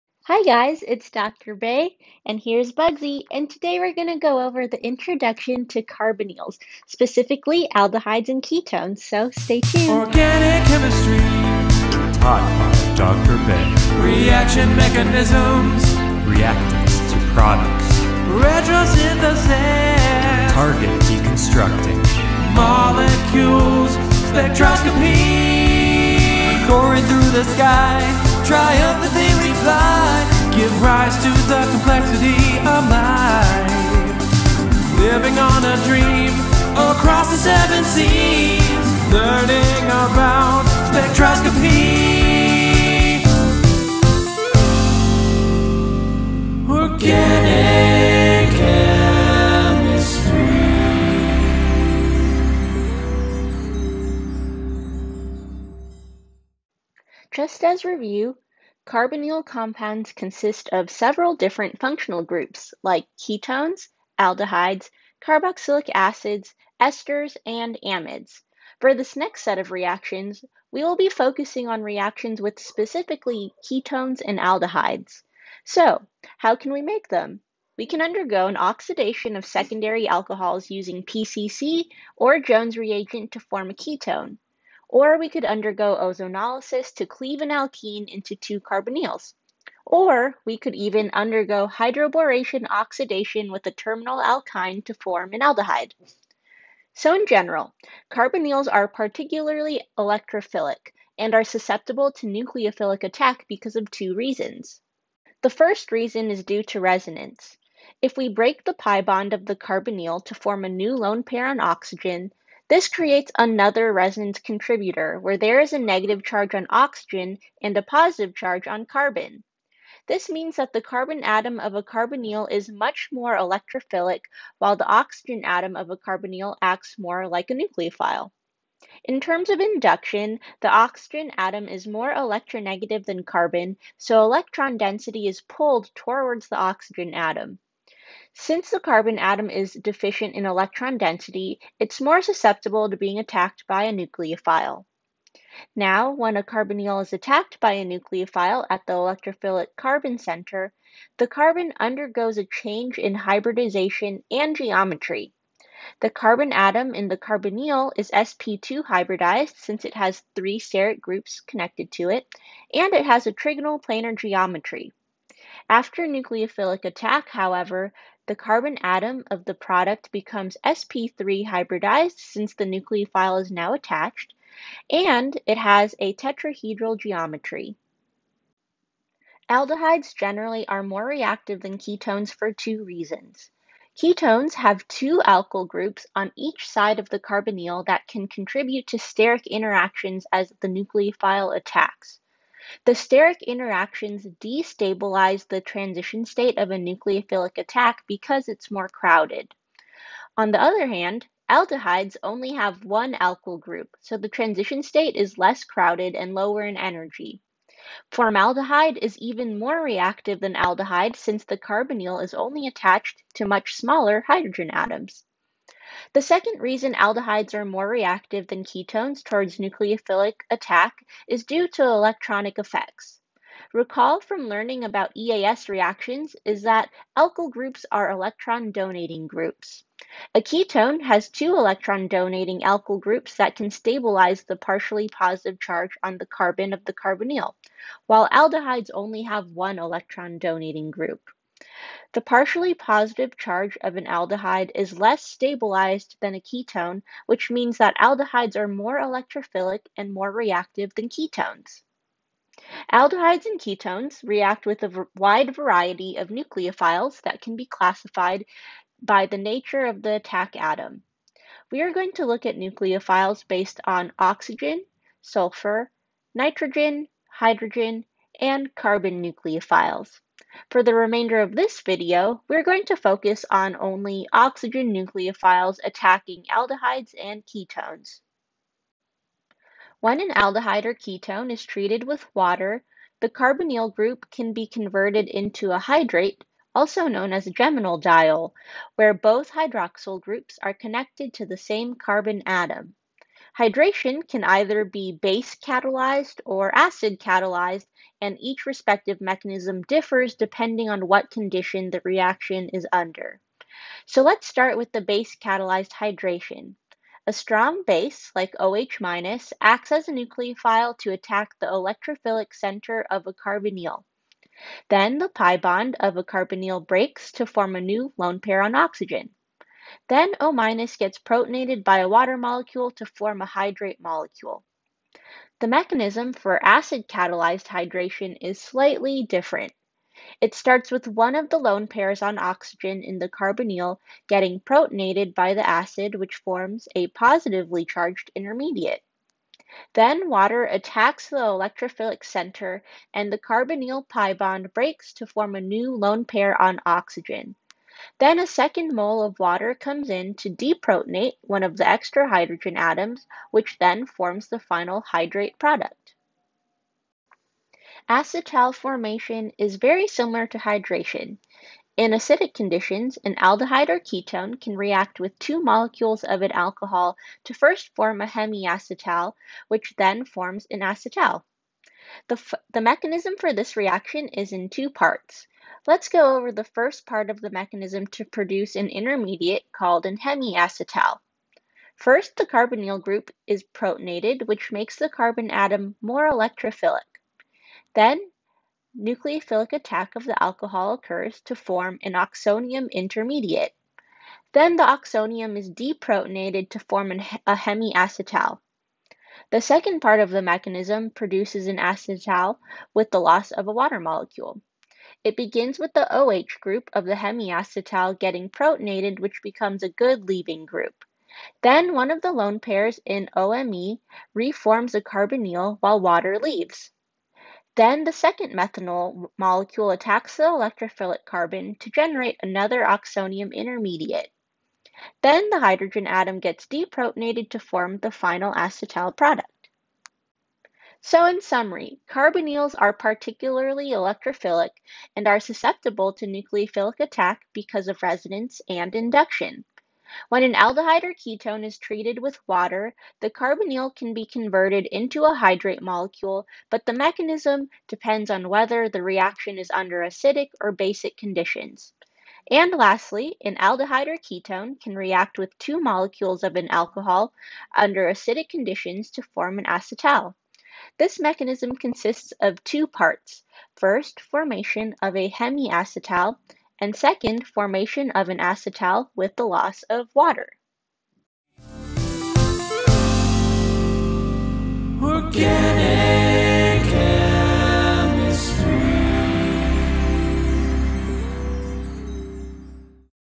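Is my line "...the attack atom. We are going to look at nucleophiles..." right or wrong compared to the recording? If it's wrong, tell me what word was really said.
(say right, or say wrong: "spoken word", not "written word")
right.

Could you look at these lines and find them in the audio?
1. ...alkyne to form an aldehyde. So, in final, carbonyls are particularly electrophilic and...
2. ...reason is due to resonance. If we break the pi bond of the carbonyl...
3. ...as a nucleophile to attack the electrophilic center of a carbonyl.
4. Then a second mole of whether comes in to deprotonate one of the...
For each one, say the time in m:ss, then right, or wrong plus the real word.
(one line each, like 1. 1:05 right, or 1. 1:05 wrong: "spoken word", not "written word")
1. 1:34 wrong: "general", not "final"
2. 1:45 right
3. 5:09 right
4. 5:48 wrong: "water", not "whether".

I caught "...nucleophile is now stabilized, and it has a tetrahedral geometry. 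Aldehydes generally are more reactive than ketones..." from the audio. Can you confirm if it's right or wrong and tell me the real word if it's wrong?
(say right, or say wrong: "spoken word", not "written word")
wrong: "attached", not "stabilized".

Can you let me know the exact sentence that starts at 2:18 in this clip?
Since the carbon atom is deficient in electron density, it's more susceptible to being attacked by a nucleophile.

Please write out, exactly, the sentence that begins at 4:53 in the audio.
Hydration can either be base catalyzed or acid catalyzed, and each respective mechanism differs depending on what condition the reaction is under.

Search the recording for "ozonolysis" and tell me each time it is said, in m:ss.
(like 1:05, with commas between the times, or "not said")
1:25.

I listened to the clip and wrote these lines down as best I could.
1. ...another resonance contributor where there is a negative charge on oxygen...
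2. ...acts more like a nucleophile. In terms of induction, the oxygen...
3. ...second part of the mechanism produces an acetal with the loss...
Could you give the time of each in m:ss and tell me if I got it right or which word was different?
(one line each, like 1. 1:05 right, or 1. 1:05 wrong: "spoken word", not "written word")
1. 1:53 right
2. 2:06 right
3. 6:39 right.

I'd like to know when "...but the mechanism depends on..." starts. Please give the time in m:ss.
7:26.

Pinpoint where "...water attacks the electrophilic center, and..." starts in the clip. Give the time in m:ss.
5:40.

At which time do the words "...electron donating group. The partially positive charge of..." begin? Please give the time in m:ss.
3:59.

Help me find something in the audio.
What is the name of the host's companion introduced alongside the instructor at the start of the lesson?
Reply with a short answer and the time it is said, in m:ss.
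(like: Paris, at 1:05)
Bugsy, at 0:02.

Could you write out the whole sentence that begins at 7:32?
And lastly, an aldehyde or ketone can react with two molecules of an alcohol under acidic conditions to form an acetal.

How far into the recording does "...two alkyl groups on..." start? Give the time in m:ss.
3:04.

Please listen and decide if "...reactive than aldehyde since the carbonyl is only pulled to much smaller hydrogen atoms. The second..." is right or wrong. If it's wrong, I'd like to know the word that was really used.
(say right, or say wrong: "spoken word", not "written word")
wrong: "attached", not "pulled".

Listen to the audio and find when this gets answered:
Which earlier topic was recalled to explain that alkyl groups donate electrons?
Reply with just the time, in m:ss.
3:45.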